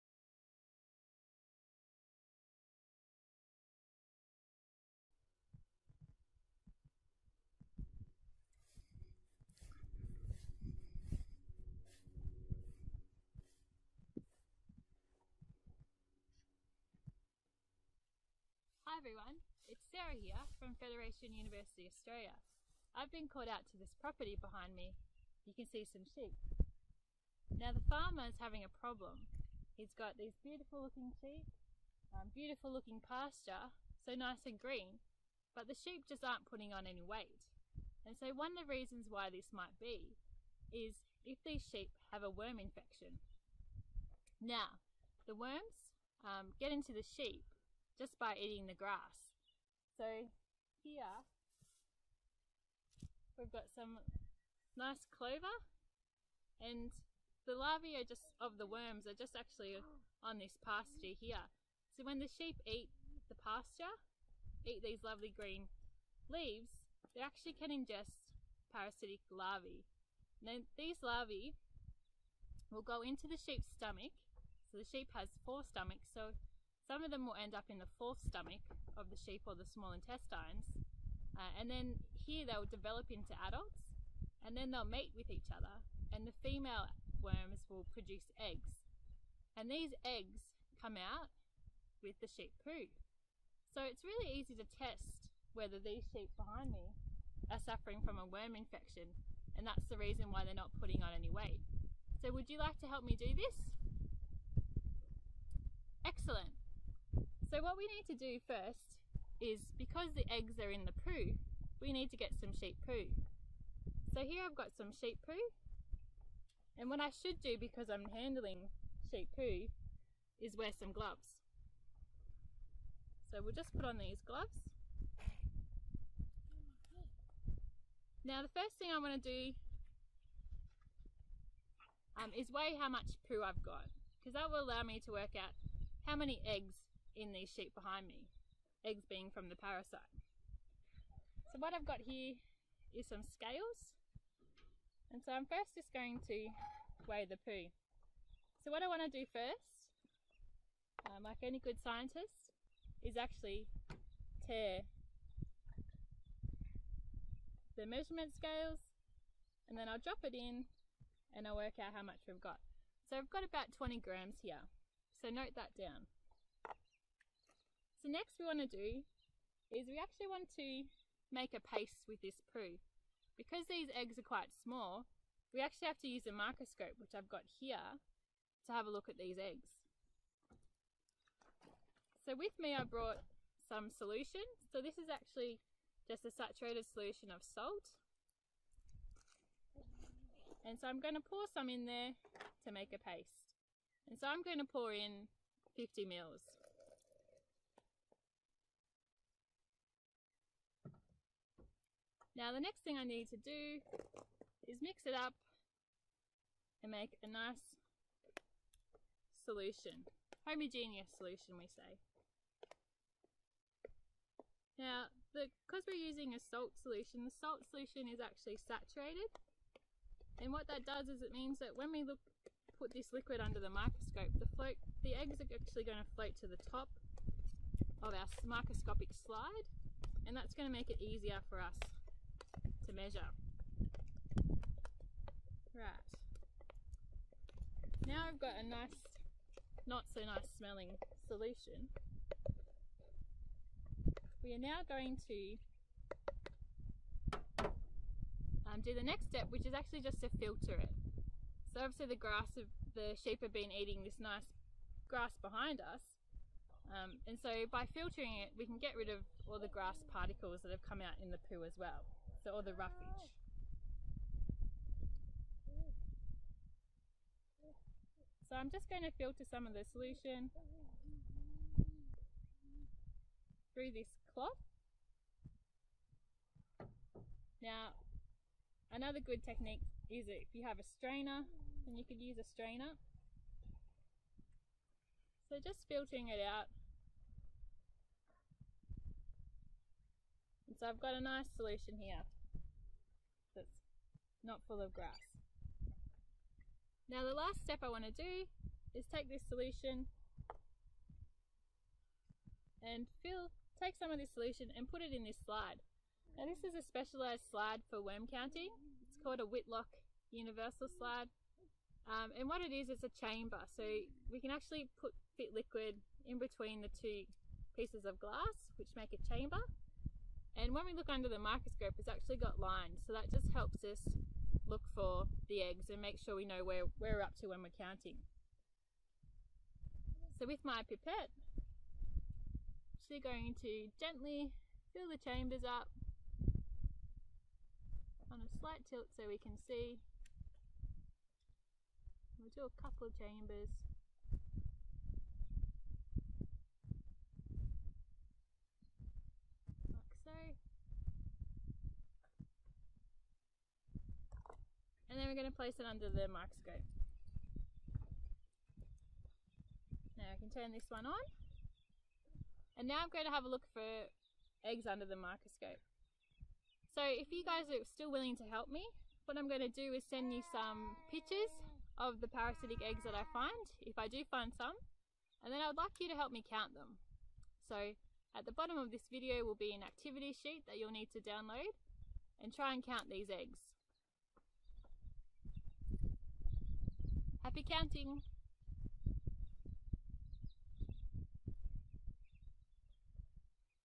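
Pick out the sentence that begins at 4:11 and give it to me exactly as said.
So obviously the grass of the sheep have been eating this nice grass behind us.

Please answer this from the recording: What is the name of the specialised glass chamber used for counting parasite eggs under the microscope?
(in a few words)
Whitlock universal slide.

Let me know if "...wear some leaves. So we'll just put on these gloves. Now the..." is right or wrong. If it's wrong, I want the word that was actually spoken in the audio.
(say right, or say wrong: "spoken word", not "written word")
wrong: "gloves", not "leaves".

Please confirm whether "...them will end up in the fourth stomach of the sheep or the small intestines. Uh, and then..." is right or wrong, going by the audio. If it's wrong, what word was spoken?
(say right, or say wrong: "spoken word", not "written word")
right.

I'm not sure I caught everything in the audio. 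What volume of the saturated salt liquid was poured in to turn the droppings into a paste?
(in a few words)
50 mils.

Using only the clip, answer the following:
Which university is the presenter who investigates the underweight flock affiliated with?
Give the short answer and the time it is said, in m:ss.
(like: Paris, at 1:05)
Federation University Australia, at 0:20.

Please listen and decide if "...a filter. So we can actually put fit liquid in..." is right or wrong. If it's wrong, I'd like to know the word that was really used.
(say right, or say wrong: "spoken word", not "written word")
wrong: "chamber", not "filter".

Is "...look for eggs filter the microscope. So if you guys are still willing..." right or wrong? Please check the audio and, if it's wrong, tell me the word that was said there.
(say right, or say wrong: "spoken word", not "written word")
wrong: "under", not "filter".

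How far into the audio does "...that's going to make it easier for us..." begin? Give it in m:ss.
3:50.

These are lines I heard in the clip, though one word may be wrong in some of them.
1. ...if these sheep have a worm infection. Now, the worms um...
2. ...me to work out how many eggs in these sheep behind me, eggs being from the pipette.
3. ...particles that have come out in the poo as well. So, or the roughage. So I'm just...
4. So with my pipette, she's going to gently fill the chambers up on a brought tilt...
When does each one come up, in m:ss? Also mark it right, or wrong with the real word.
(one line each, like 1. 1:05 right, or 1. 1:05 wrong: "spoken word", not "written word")
1. 0:41 right
2. 2:14 wrong: "parasite", not "pipette"
3. 4:20 right
4. 5:30 wrong: "slight", not "brought".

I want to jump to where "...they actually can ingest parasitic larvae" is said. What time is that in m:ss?
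1:07.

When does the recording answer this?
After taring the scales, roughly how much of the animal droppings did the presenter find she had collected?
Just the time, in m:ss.
2:43.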